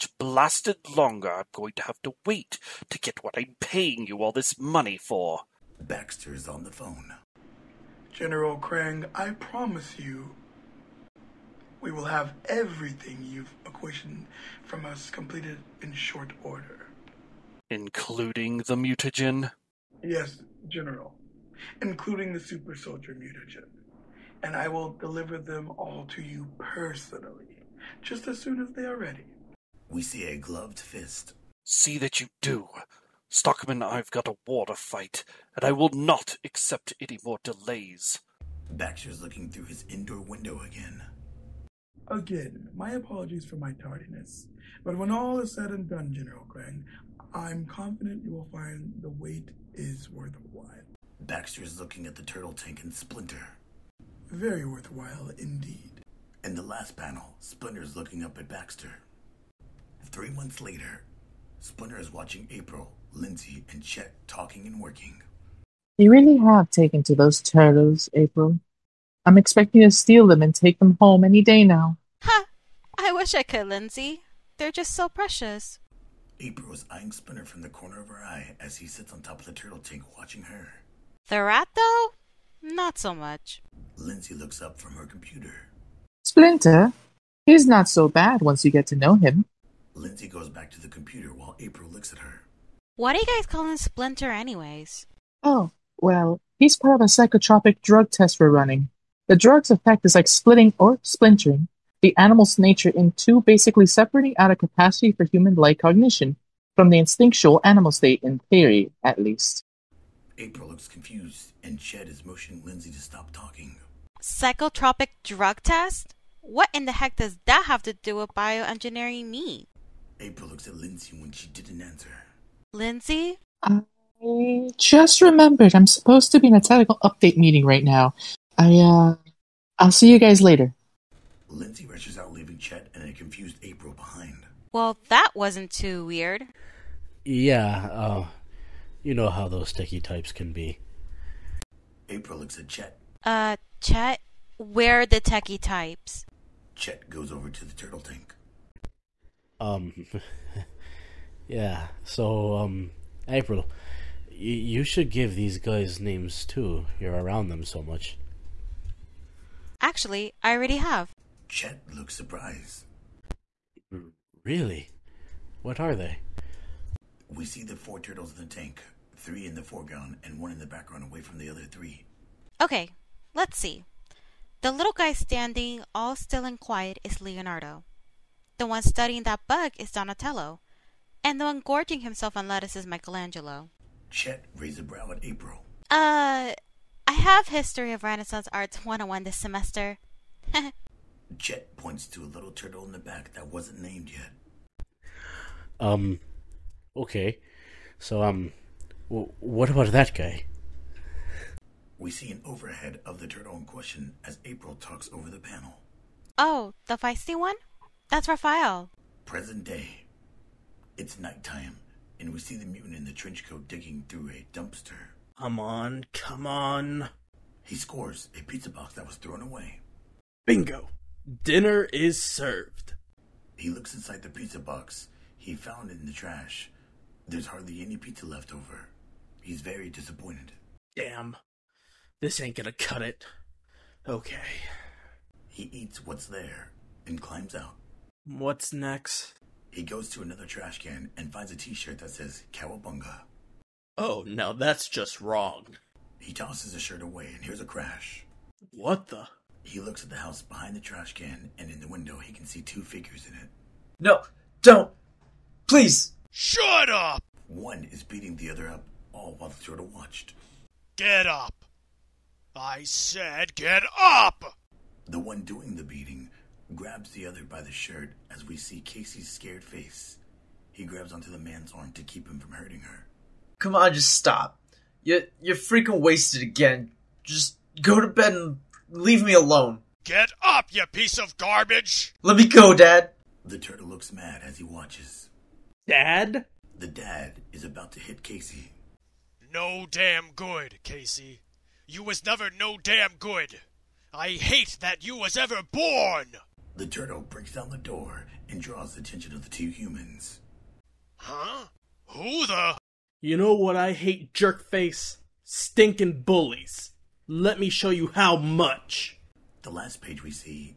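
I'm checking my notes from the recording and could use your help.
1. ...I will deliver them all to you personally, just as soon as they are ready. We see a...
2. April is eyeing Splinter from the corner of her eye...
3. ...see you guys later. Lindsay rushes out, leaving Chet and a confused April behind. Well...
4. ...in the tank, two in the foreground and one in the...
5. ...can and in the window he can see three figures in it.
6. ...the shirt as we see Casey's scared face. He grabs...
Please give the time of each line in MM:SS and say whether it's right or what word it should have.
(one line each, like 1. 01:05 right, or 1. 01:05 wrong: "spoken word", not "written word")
1. 00:24 right
2. 01:16 right
3. 02:09 right
4. 02:48 wrong: "three", not "two"
5. 04:11 wrong: "two", not "three"
6. 04:27 right.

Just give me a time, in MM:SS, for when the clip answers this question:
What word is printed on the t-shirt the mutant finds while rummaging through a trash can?
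04:02.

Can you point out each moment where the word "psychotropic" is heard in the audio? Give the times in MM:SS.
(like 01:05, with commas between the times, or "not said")
01:37, 01:54.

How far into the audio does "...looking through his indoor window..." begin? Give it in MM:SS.
00:39.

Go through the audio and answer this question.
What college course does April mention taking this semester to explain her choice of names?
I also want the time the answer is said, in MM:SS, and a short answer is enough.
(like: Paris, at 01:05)
History of Renaissance Arts 101, at 03:07.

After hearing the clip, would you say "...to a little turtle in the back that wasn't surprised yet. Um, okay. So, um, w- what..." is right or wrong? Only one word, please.
wrong.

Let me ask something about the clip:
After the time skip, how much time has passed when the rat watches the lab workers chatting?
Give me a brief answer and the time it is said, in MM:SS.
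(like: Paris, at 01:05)
Three months, at 01:00.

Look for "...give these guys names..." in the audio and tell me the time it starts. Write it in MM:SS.
02:35.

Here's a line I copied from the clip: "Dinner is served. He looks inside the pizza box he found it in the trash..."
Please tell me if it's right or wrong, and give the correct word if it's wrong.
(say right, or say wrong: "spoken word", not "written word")
right.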